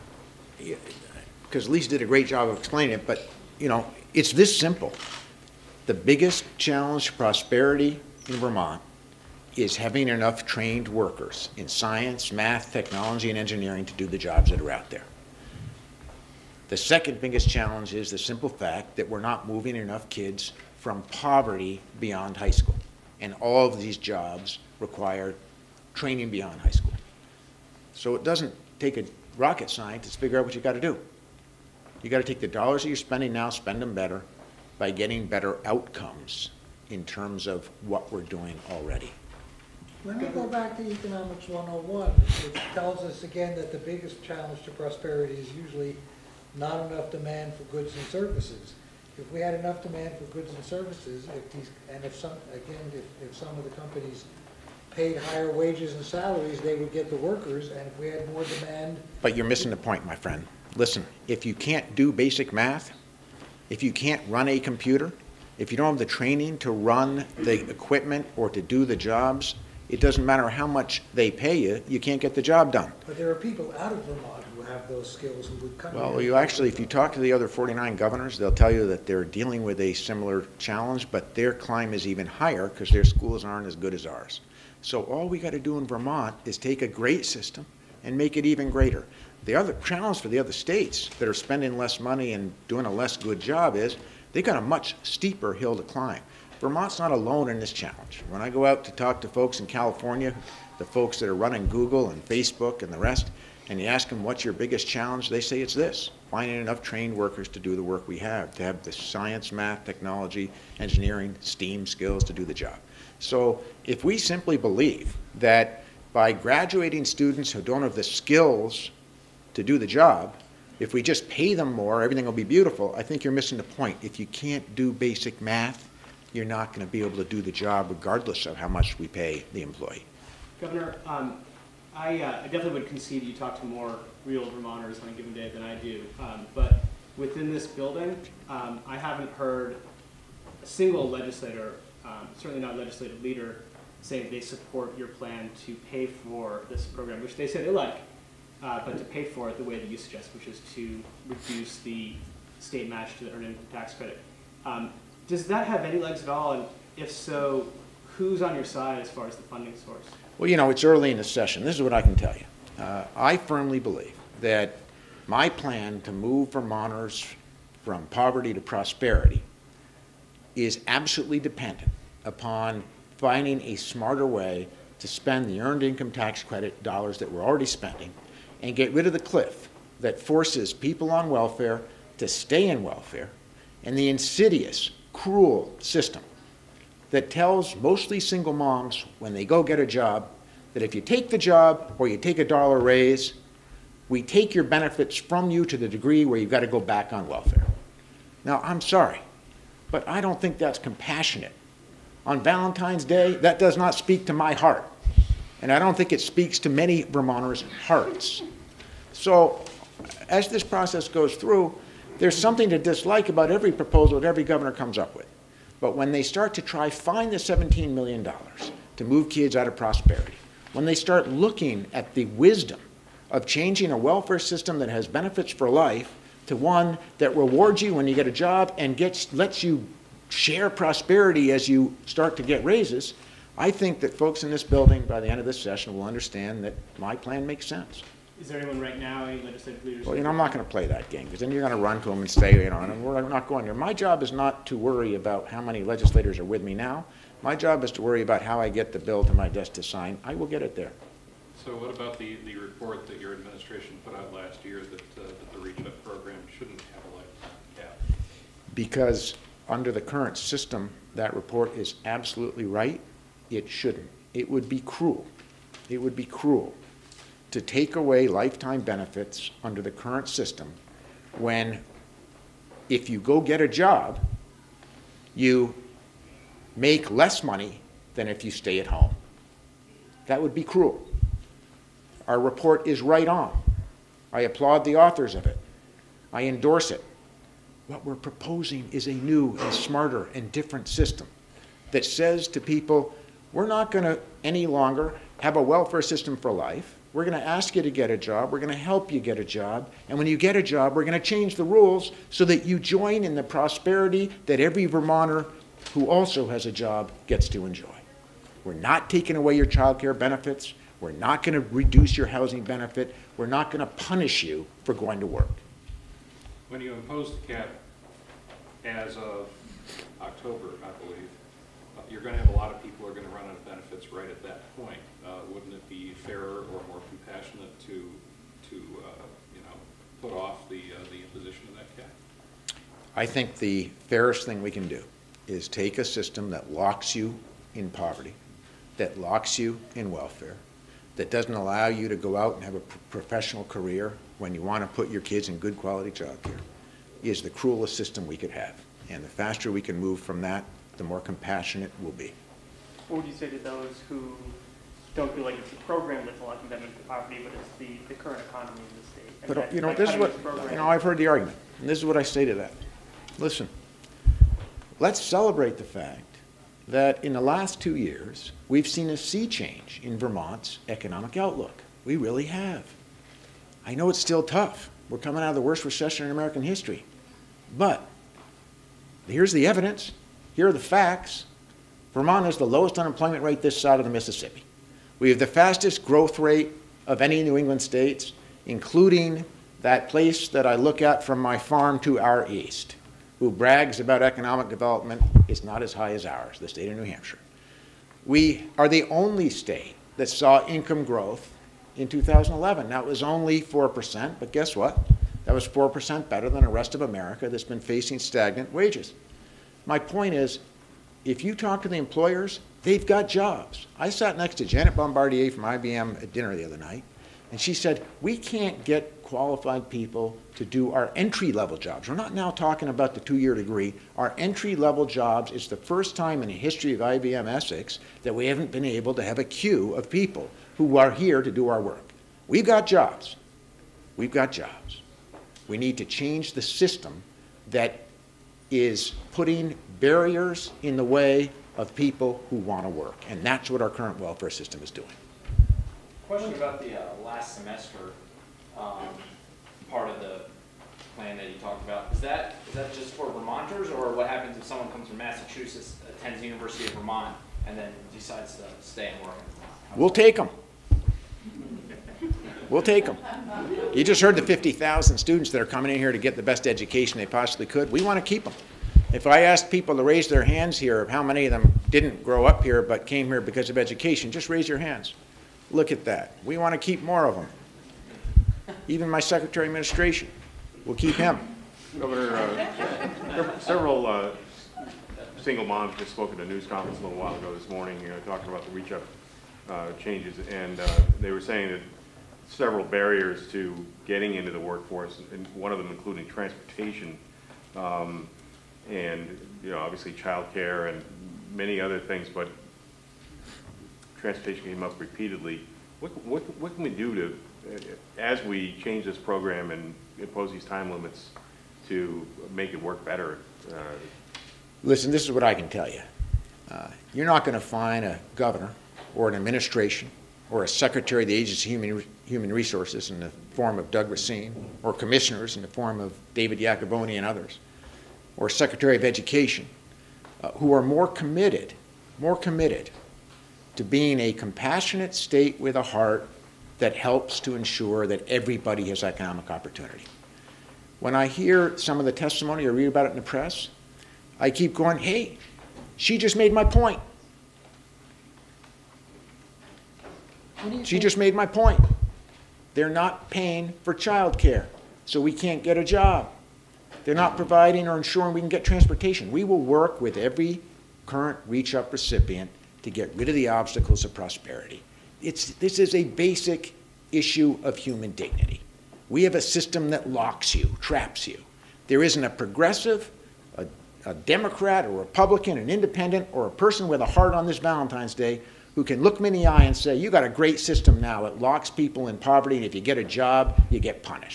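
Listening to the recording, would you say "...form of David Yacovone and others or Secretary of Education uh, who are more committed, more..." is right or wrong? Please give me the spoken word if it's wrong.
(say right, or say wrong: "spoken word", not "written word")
right.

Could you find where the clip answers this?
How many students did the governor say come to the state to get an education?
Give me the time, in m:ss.
7:44.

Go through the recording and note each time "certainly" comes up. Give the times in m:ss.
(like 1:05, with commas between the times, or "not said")
2:22.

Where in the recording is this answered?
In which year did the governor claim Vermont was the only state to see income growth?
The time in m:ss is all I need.
6:42.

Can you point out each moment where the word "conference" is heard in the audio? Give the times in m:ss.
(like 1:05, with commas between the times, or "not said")
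8:06.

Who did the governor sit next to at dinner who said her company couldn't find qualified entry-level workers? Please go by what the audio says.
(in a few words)
Janet Bombardier.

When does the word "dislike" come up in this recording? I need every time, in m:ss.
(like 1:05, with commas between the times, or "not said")
3:32.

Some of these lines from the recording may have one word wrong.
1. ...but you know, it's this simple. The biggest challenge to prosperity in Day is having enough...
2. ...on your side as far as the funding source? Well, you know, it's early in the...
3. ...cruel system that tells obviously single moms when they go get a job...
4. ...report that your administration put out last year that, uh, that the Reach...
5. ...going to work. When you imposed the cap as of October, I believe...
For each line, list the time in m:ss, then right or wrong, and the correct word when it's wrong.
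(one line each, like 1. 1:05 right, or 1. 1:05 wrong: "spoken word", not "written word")
1. 0:03 wrong: "Vermont", not "Day"
2. 2:38 right
3. 3:05 wrong: "mostly", not "obviously"
4. 4:12 right
5. 5:14 right.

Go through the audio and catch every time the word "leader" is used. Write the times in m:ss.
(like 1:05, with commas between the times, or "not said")
2:23, 3:59.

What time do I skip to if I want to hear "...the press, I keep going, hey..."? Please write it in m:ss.
9:03.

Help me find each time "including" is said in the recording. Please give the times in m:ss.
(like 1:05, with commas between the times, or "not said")
6:28, 8:15.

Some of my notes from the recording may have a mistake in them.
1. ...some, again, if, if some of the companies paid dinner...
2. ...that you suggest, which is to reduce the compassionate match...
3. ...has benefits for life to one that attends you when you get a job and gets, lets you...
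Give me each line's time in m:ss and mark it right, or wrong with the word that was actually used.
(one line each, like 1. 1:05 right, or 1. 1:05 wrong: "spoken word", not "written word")
1. 0:52 wrong: "higher", not "dinner"
2. 2:29 wrong: "state", not "compassionate"
3. 3:44 wrong: "rewards", not "attends".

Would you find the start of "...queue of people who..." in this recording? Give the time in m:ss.
7:09.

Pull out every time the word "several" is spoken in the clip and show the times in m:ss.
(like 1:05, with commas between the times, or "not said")
8:03, 8:12.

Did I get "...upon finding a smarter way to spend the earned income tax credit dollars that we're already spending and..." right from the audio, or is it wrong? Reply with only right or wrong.
right.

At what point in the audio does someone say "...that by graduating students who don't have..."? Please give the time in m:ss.
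1:55.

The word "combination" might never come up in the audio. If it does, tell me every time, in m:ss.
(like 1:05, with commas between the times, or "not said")
not said.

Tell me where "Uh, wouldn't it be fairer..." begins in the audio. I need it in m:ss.
5:25.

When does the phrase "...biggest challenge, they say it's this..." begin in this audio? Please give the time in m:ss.
1:44.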